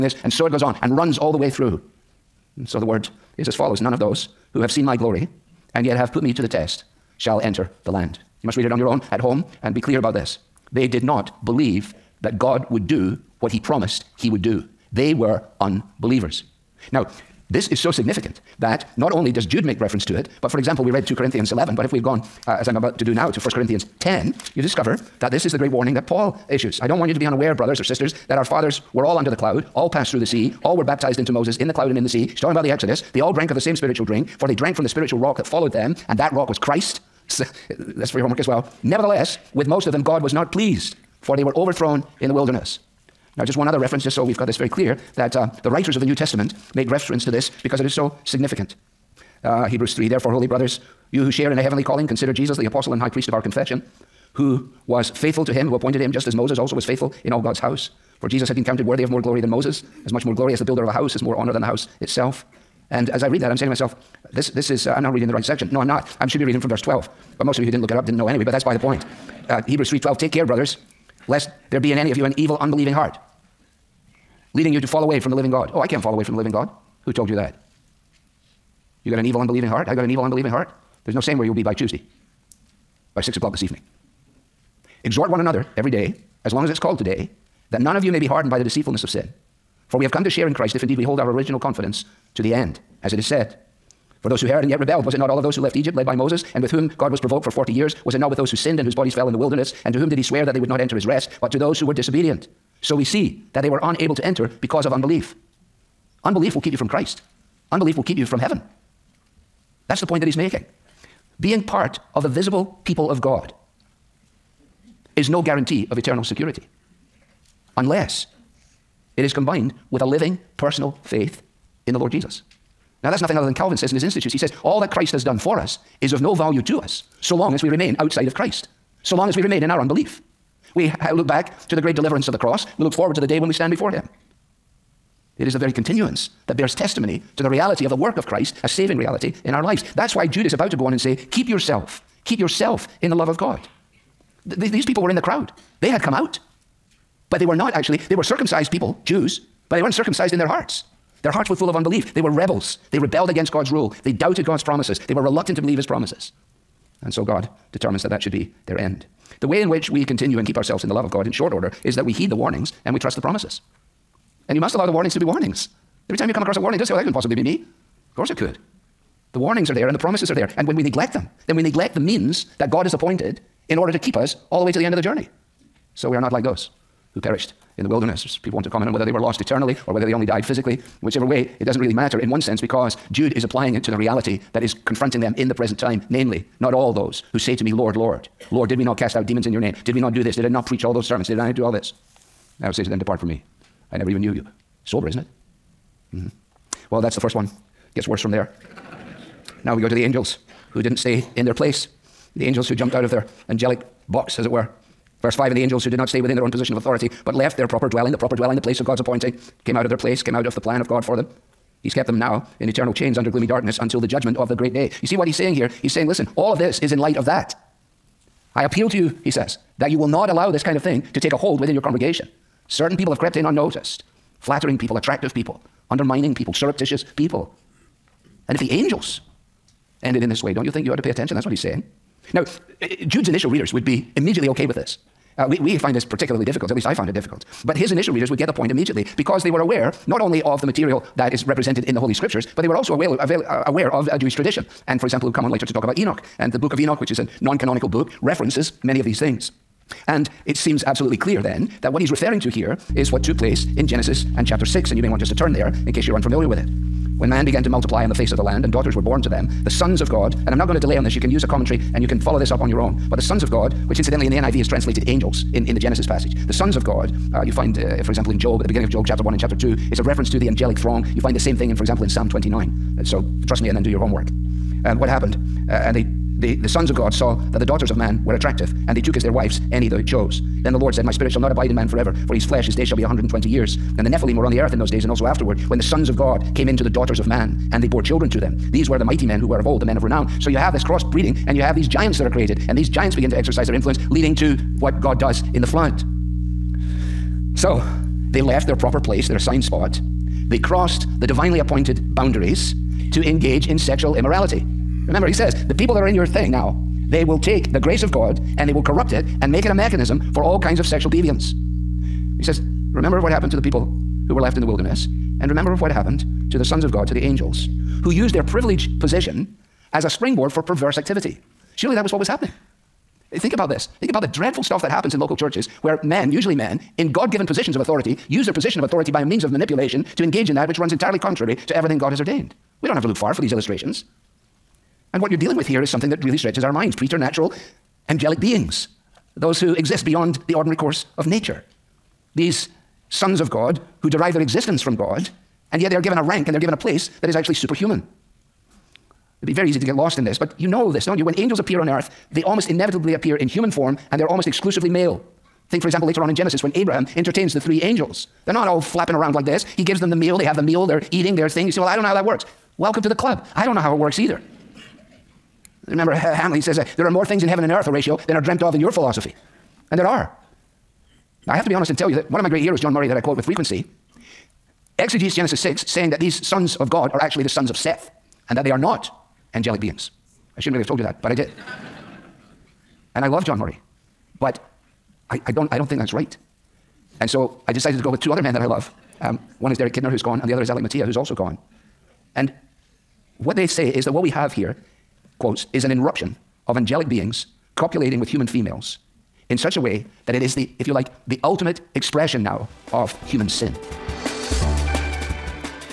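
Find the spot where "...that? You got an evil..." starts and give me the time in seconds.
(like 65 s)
77 s.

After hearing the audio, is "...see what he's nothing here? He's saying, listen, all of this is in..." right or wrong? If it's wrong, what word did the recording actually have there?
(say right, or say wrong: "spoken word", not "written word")
wrong: "saying", not "nothing".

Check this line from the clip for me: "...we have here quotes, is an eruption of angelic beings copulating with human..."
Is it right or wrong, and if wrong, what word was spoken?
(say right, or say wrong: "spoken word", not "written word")
right.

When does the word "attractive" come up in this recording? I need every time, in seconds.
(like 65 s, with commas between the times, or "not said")
224 s, 278 s.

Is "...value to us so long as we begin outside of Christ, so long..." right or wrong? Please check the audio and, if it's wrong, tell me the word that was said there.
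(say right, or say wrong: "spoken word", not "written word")
wrong: "remain", not "begin".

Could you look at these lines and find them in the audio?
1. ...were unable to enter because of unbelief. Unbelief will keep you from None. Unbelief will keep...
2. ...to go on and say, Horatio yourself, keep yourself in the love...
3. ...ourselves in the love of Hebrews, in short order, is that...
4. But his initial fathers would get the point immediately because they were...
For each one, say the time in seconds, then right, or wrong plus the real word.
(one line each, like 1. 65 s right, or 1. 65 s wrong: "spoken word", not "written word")
1. 103 s wrong: "Christ", not "None"
2. 140 s wrong: "Keep", not "Horatio"
3. 160 s wrong: "God", not "Hebrews"
4. 237 s wrong: "readers", not "fathers".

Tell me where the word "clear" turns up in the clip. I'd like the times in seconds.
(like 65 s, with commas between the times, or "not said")
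9 s, 44 s, 251 s.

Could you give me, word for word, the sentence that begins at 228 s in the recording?
And if the angels ended in this way, don't you think you ought to pay attention?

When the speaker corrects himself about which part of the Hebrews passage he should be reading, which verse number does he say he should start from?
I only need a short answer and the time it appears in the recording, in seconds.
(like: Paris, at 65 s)
12, at 66 s.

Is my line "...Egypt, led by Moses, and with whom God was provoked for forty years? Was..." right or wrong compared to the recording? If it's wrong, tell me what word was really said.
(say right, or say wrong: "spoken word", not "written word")
right.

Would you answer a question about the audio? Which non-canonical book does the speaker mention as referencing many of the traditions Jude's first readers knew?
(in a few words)
The book of Enoch.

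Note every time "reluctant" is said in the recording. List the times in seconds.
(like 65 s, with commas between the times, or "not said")
155 s.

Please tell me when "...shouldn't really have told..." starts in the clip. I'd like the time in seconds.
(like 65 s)
380 s.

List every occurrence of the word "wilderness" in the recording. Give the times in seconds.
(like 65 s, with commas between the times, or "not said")
42 s, 99 s, 177 s, 314 s.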